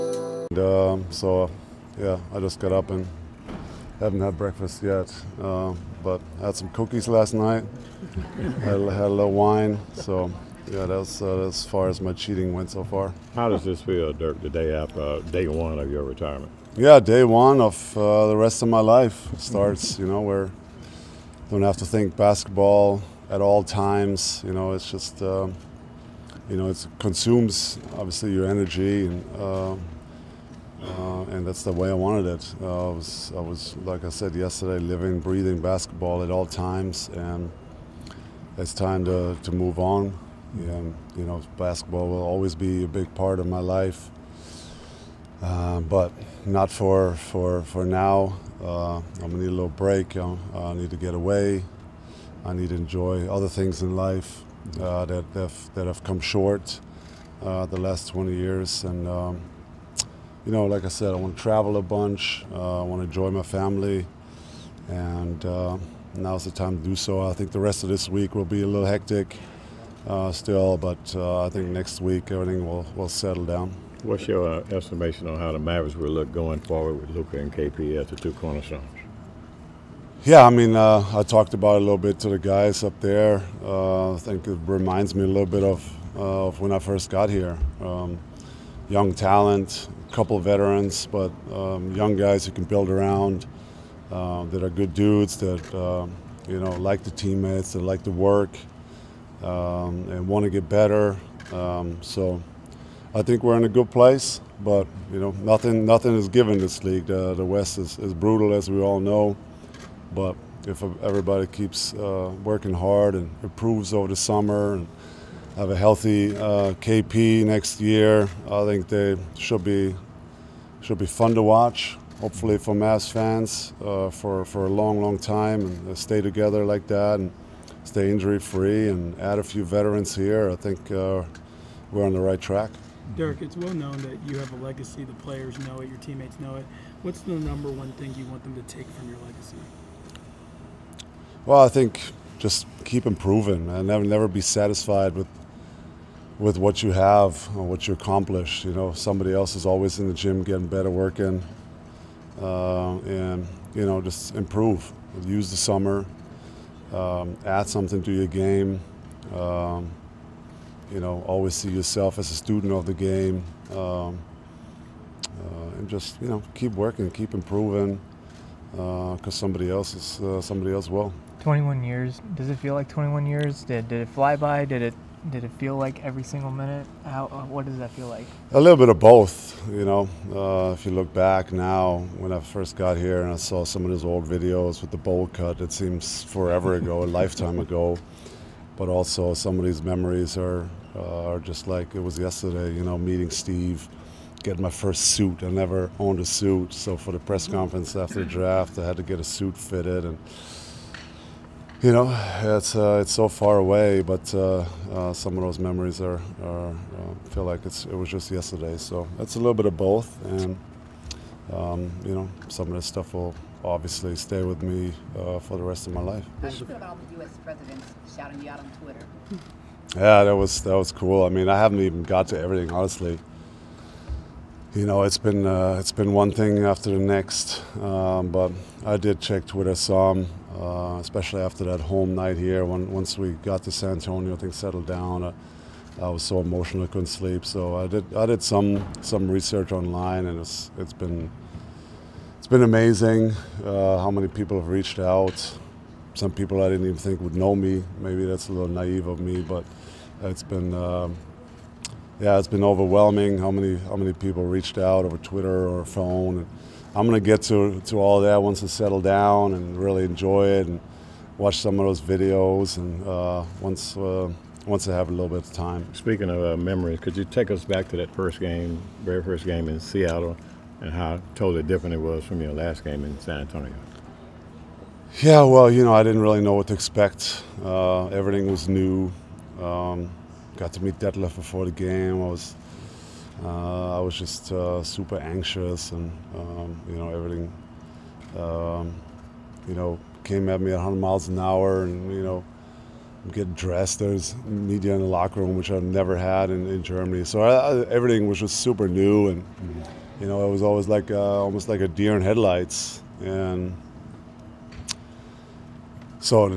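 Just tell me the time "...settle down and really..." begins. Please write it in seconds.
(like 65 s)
258 s.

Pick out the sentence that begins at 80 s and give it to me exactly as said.
Yeah, I mean, uh, I talked about a little bit to the guys up there.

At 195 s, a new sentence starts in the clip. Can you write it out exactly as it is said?
I never owned a suit, so for the press mm-hmm.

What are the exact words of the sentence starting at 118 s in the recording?
I think they should be should be fun to watch.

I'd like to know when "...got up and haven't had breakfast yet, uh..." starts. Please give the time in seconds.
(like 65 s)
2 s.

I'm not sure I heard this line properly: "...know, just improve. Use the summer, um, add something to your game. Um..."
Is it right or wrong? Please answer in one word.
right.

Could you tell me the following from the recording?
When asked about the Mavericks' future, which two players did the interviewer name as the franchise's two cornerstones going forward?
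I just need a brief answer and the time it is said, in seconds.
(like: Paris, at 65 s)
Luka and KP, at 77 s.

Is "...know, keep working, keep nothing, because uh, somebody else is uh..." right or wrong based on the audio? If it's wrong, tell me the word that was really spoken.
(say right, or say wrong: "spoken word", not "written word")
wrong: "improving", not "nothing".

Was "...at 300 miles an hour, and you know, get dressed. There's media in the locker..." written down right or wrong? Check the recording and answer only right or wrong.
wrong.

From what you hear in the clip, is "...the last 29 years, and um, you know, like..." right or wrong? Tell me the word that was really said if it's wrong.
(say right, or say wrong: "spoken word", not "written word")
wrong: "20", not "29".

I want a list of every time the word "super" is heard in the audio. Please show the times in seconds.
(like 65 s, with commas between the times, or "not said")
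284 s, 298 s.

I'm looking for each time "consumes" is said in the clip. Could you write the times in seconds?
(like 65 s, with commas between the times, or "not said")
26 s.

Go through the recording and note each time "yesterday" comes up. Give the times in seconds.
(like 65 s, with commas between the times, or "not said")
34 s, 192 s, 208 s.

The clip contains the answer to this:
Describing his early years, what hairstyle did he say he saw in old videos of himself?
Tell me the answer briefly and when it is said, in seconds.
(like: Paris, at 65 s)
Bowl cut, at 184 s.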